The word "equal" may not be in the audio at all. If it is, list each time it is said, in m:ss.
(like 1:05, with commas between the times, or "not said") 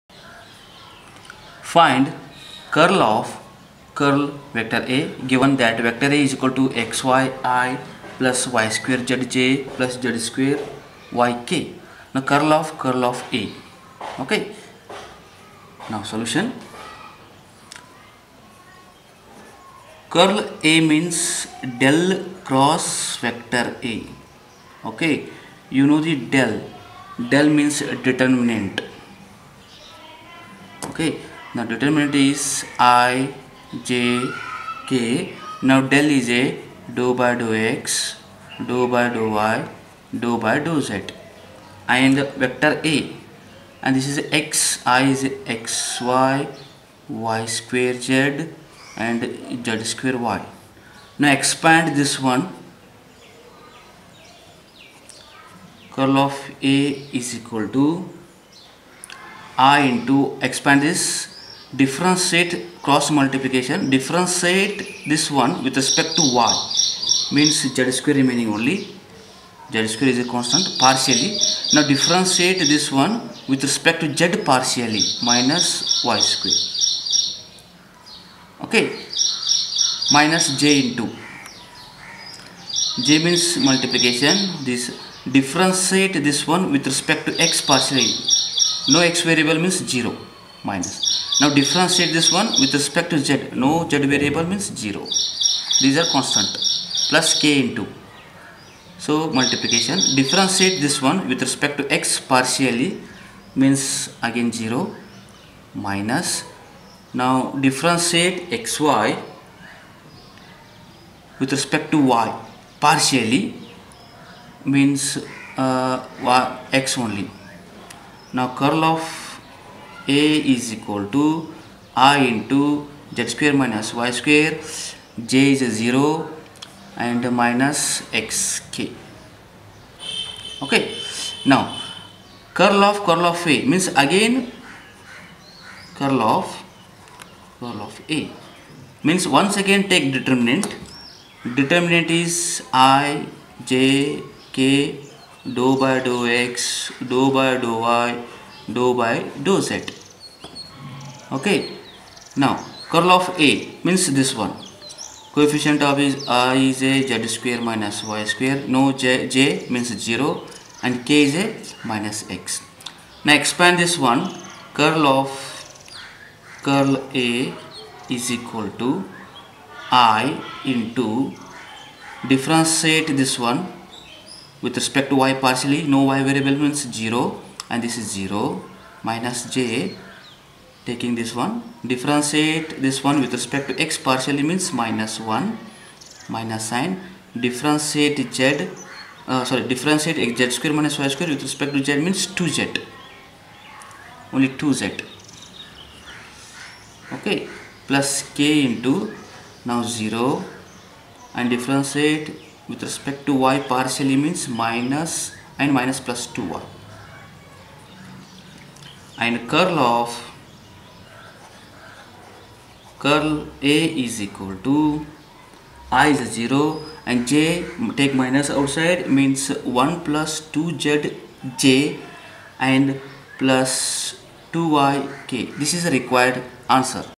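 0:06, 0:57, 2:00, 2:48, 3:34.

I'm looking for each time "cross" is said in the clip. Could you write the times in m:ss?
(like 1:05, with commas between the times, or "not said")
0:22, 1:02.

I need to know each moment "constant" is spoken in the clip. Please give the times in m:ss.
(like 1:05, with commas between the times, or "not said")
1:10, 1:36.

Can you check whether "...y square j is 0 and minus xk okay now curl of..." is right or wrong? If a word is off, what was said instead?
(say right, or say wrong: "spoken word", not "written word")
right.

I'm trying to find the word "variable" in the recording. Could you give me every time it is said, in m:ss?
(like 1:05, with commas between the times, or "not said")
1:29, 1:34, 2:56.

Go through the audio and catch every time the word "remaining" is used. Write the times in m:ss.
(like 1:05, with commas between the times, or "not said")
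1:08.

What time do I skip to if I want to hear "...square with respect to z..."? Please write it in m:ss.
3:11.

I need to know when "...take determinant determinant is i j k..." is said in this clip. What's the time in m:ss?
2:19.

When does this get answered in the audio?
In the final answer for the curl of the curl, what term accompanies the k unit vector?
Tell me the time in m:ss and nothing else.
3:44.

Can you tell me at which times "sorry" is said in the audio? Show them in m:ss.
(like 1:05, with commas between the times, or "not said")
3:09.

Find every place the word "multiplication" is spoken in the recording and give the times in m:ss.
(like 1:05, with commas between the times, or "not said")
1:03, 1:23, 1:39.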